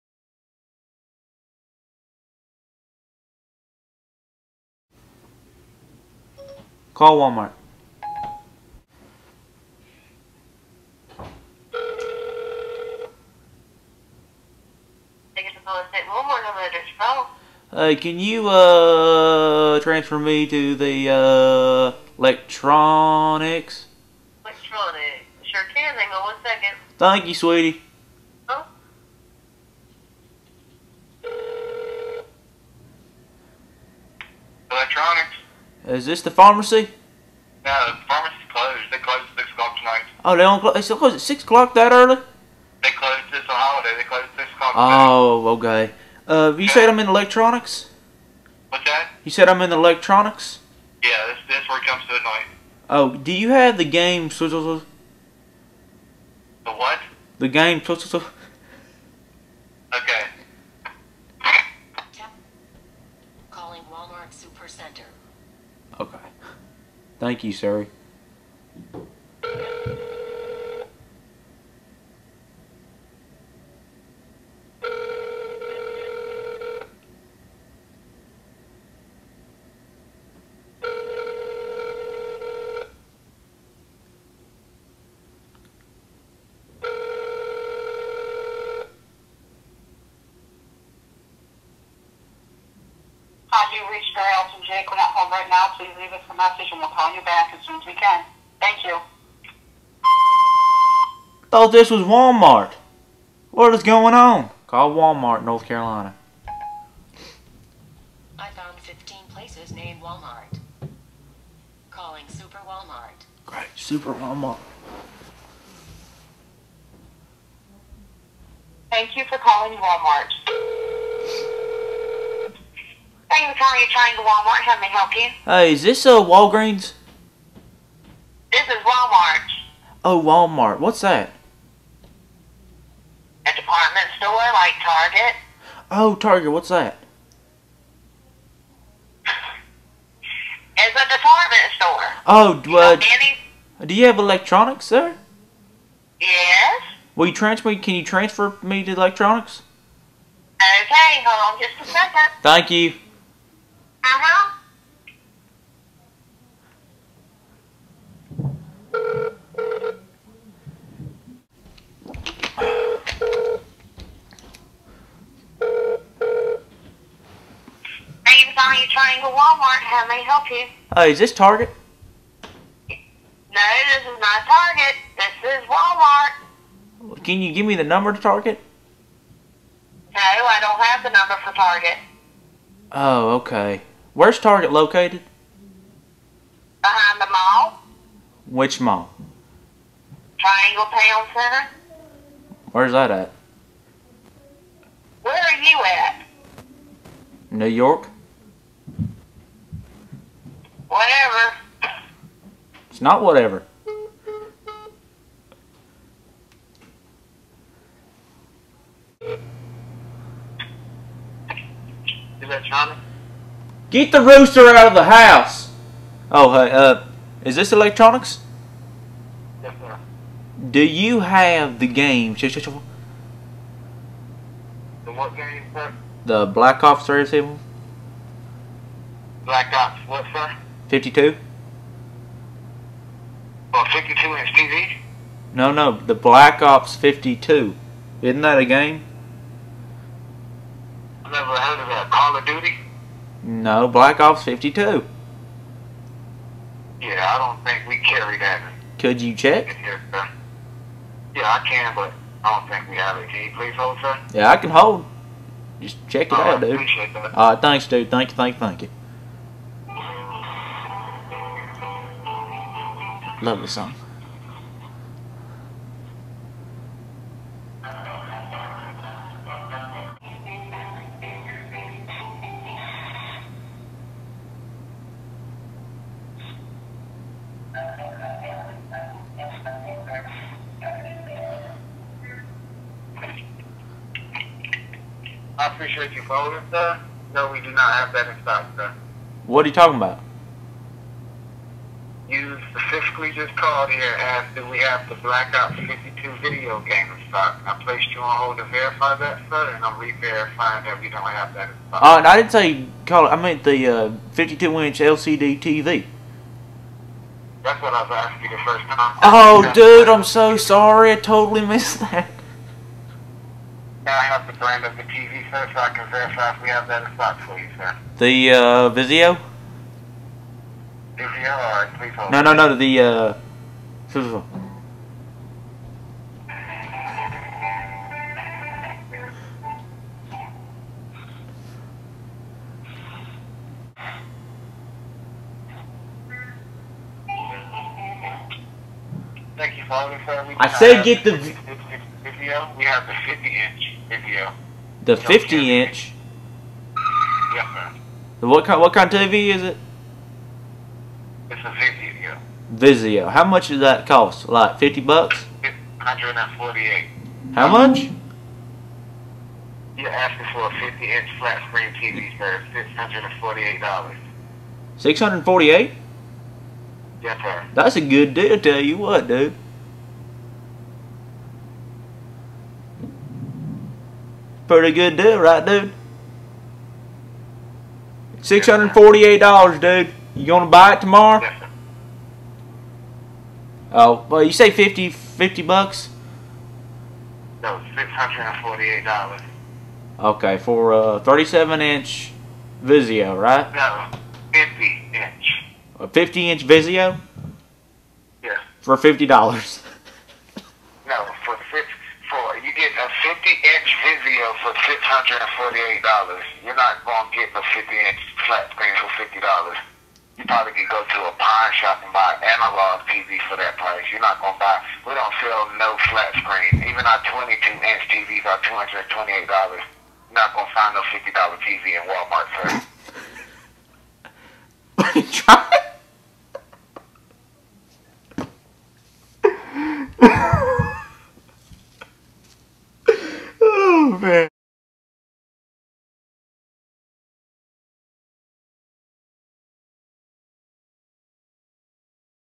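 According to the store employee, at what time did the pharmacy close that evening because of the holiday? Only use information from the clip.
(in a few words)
6 o'clock.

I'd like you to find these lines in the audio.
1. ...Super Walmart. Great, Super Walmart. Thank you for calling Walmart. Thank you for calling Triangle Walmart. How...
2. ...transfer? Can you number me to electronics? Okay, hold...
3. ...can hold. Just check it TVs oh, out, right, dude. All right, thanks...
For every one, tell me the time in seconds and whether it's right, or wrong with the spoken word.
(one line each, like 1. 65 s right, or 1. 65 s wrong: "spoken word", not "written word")
1. 112 s right
2. 147 s wrong: "transfer", not "number"
3. 254 s wrong: "All", not "TVs".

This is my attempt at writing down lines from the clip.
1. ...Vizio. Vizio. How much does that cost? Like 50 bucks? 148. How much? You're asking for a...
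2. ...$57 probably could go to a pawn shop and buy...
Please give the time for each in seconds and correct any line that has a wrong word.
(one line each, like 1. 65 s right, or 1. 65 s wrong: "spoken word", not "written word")
1. 351 s right
2. 409 s wrong: "50", not "57".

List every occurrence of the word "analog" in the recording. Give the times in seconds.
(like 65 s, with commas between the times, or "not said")
412 s.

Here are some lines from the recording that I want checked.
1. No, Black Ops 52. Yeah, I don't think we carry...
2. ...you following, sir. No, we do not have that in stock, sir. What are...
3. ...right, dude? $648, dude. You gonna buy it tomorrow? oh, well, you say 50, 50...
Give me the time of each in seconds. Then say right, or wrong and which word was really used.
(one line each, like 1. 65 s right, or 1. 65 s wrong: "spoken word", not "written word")
1. 243 s right
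2. 286 s right
3. 375 s right.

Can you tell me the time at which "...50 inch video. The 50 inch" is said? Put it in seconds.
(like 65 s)
343 s.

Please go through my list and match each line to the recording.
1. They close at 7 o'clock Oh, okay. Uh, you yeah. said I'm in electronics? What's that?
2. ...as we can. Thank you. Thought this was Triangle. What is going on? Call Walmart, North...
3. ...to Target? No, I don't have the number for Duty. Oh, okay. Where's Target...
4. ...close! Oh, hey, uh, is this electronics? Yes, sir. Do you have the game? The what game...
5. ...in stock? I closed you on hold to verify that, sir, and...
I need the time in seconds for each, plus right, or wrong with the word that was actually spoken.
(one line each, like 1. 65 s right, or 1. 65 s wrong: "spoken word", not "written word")
1. 43 s wrong: "6", not "7"
2. 97 s wrong: "Walmart", not "Triangle"
3. 178 s wrong: "Target", not "Duty"
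4. 215 s wrong: "house", not "close"
5. 297 s wrong: "placed", not "closed".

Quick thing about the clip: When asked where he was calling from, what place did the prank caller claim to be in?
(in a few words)
New York.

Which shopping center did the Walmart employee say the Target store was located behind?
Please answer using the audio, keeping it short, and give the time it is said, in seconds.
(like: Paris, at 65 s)
Triangle Town Center, at 190 s.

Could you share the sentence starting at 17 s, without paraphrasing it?
Hey, uh, can you uh, transfer me to the uh, electronics?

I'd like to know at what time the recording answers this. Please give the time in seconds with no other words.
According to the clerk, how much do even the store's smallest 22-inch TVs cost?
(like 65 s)
418 s.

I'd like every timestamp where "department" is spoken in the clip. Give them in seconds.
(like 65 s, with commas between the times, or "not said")
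133 s, 141 s.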